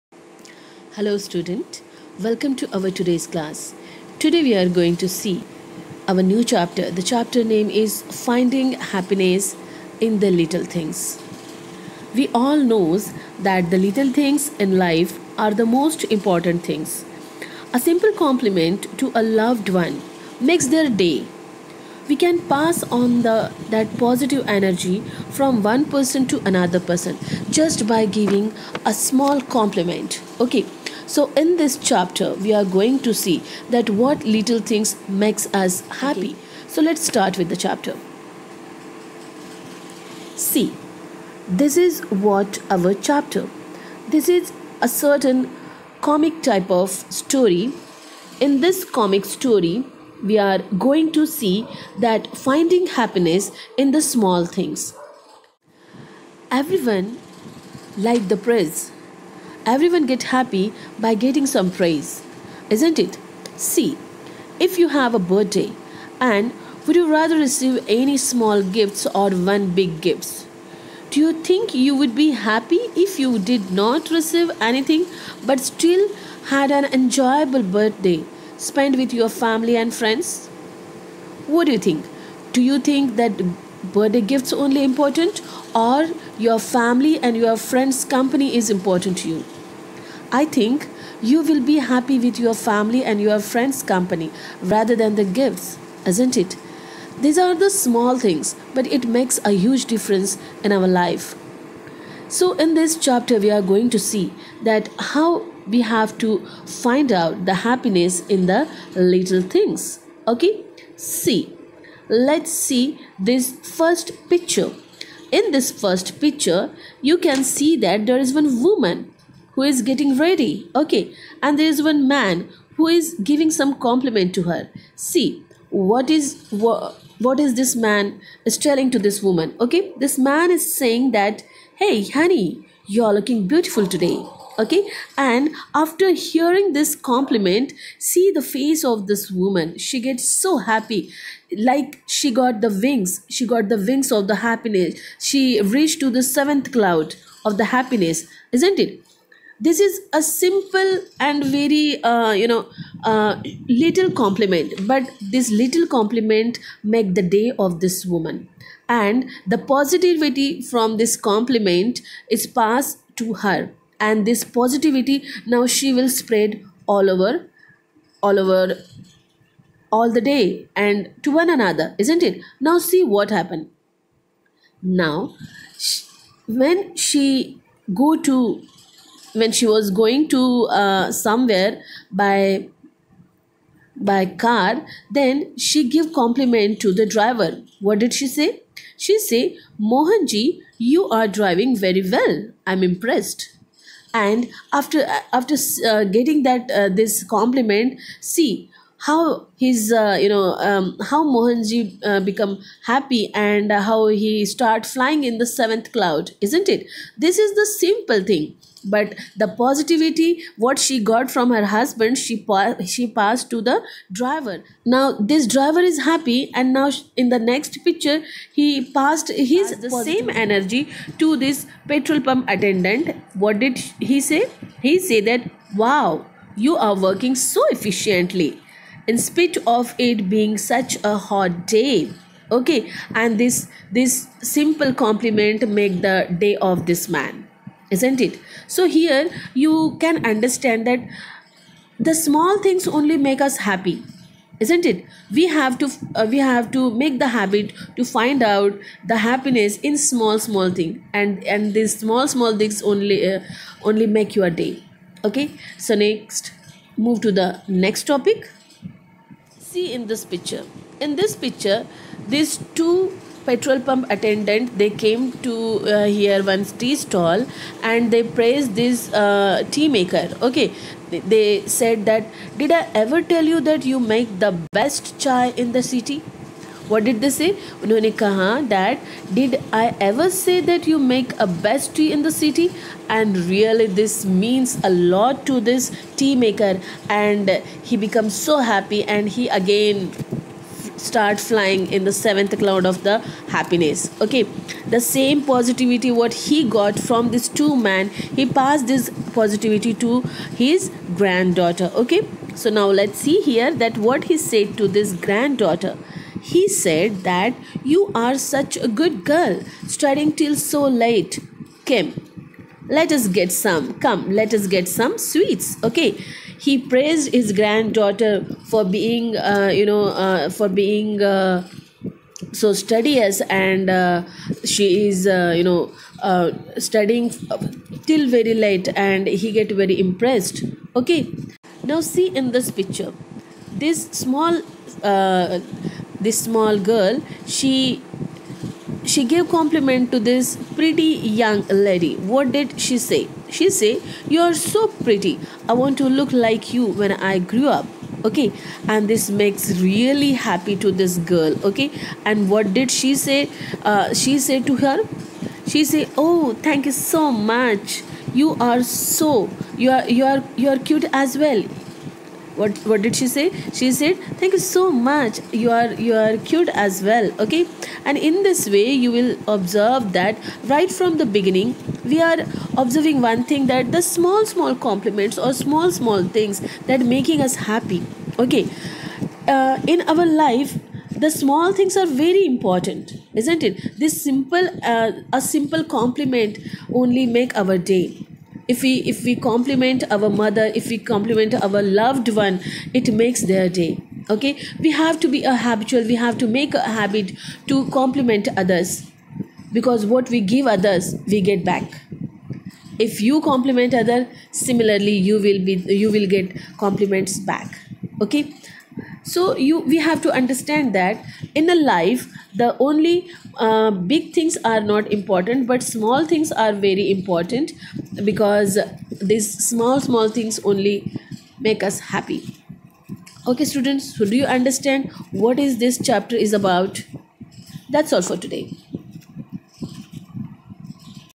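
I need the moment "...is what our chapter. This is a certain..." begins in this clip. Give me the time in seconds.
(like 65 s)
41 s.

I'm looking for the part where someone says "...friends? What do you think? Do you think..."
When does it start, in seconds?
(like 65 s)
79 s.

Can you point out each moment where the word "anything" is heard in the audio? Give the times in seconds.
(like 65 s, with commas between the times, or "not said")
74 s.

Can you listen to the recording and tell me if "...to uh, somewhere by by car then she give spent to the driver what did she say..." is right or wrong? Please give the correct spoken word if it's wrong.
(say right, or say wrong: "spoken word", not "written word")
wrong: "compliment", not "spent".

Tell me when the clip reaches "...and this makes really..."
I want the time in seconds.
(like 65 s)
348 s.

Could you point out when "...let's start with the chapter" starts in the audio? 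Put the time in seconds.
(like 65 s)
36 s.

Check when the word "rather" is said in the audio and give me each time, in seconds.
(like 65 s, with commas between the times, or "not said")
67 s, 94 s.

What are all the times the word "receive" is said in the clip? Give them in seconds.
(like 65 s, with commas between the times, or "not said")
67 s, 74 s.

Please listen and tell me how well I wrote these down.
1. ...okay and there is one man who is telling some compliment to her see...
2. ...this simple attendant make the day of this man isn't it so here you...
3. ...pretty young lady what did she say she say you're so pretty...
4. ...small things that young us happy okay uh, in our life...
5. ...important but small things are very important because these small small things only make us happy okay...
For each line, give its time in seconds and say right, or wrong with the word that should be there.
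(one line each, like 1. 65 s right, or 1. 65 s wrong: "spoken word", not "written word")
1. 120 s wrong: "giving", not "telling"
2. 233 s wrong: "compliment", not "attendant"
3. 340 s right
4. 375 s wrong: "making", not "young"
5. 415 s right.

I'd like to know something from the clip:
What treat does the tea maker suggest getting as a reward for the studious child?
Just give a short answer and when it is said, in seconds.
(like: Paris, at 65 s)
Sweets, at 315 s.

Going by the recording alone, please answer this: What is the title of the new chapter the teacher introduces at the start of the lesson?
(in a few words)
Finding Happiness in the Little Things.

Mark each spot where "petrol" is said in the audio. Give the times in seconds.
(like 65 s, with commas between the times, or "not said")
221 s, 263 s.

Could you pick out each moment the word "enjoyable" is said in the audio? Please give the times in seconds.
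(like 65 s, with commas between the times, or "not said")
76 s.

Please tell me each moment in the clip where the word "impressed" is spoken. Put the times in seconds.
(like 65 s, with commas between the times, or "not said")
192 s, 329 s.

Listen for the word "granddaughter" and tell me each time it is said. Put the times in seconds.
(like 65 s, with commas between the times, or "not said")
301 s, 305 s, 317 s.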